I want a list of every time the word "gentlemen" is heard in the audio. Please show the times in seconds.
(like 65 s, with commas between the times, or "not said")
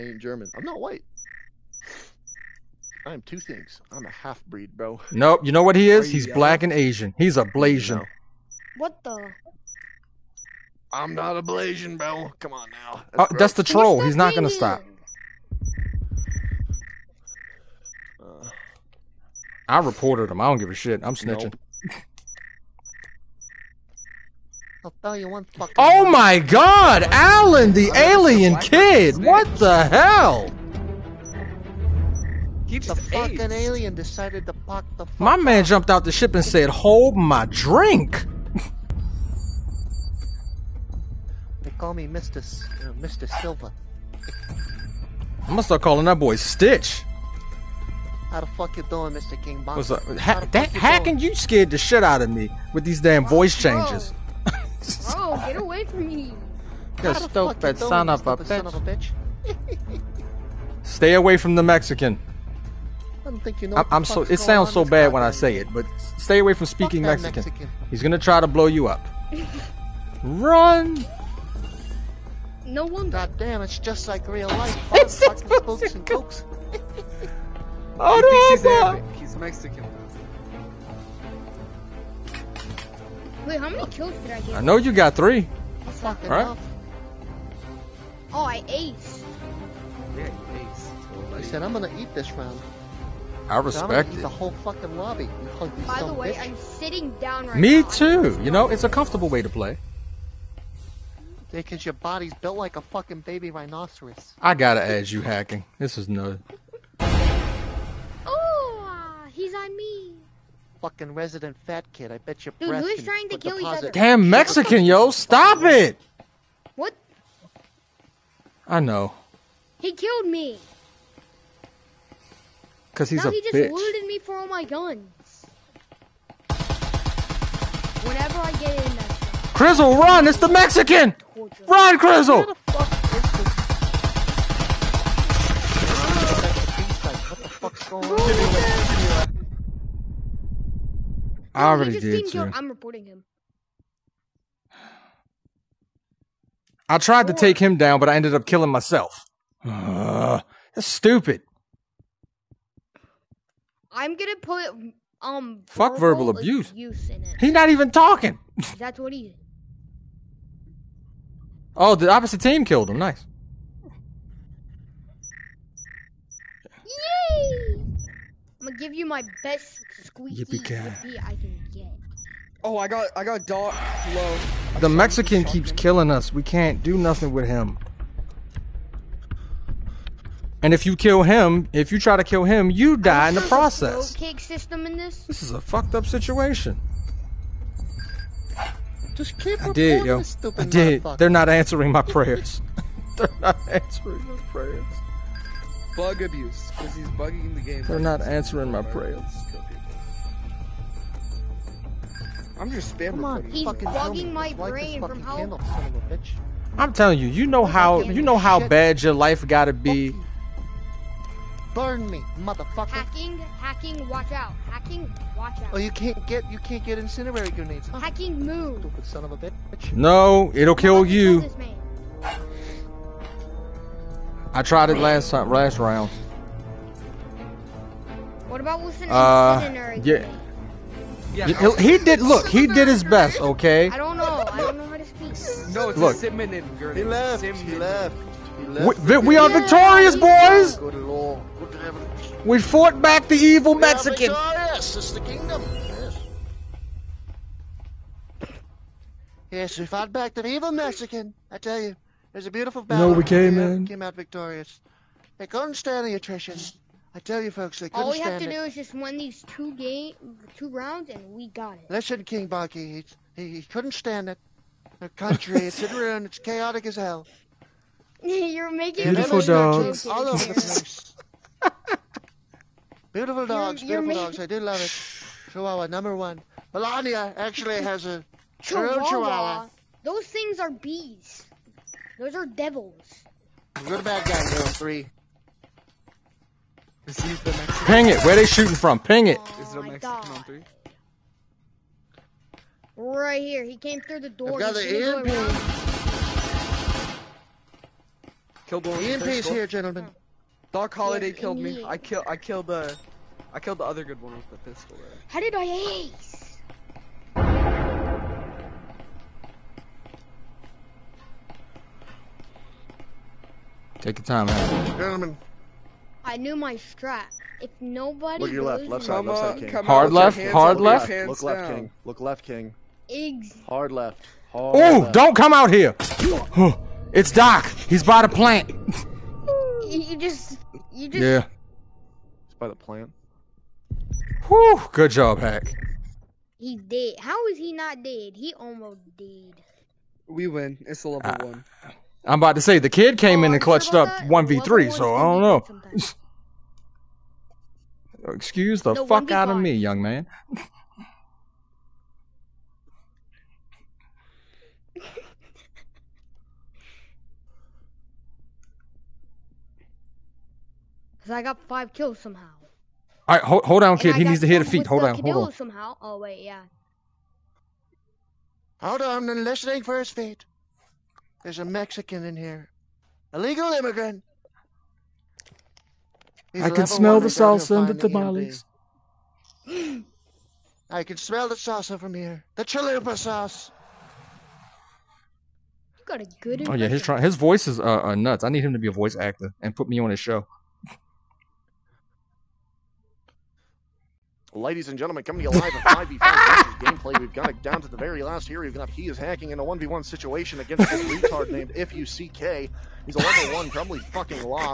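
299 s, 314 s, 394 s.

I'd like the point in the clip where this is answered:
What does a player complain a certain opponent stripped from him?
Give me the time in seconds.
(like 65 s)
124 s.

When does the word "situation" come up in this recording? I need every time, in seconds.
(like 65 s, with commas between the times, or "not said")
186 s, 400 s.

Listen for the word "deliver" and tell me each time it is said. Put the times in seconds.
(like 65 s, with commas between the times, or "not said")
not said.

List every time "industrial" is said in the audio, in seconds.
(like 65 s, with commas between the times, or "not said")
not said.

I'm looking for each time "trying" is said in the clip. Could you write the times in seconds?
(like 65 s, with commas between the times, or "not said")
113 s.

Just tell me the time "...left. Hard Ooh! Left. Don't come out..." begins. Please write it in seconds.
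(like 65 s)
323 s.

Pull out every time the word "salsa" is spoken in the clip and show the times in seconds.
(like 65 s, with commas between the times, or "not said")
377 s, 381 s.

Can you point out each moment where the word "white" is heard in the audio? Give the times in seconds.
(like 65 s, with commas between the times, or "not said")
0 s.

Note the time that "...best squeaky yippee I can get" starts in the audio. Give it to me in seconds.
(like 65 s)
169 s.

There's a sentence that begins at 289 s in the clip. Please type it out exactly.
Oh, Is a Mexican on three?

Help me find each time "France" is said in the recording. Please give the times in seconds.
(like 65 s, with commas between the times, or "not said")
not said.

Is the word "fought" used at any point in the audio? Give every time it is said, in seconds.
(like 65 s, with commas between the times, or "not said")
242 s, 249 s.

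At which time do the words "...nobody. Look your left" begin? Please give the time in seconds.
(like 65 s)
317 s.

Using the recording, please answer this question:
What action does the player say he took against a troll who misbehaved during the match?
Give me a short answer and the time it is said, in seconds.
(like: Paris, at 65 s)
Reported him, at 19 s.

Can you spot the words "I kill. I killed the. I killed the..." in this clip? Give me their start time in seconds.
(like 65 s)
301 s.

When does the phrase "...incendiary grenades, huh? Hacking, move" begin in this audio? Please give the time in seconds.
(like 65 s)
216 s.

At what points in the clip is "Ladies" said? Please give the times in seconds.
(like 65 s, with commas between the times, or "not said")
394 s.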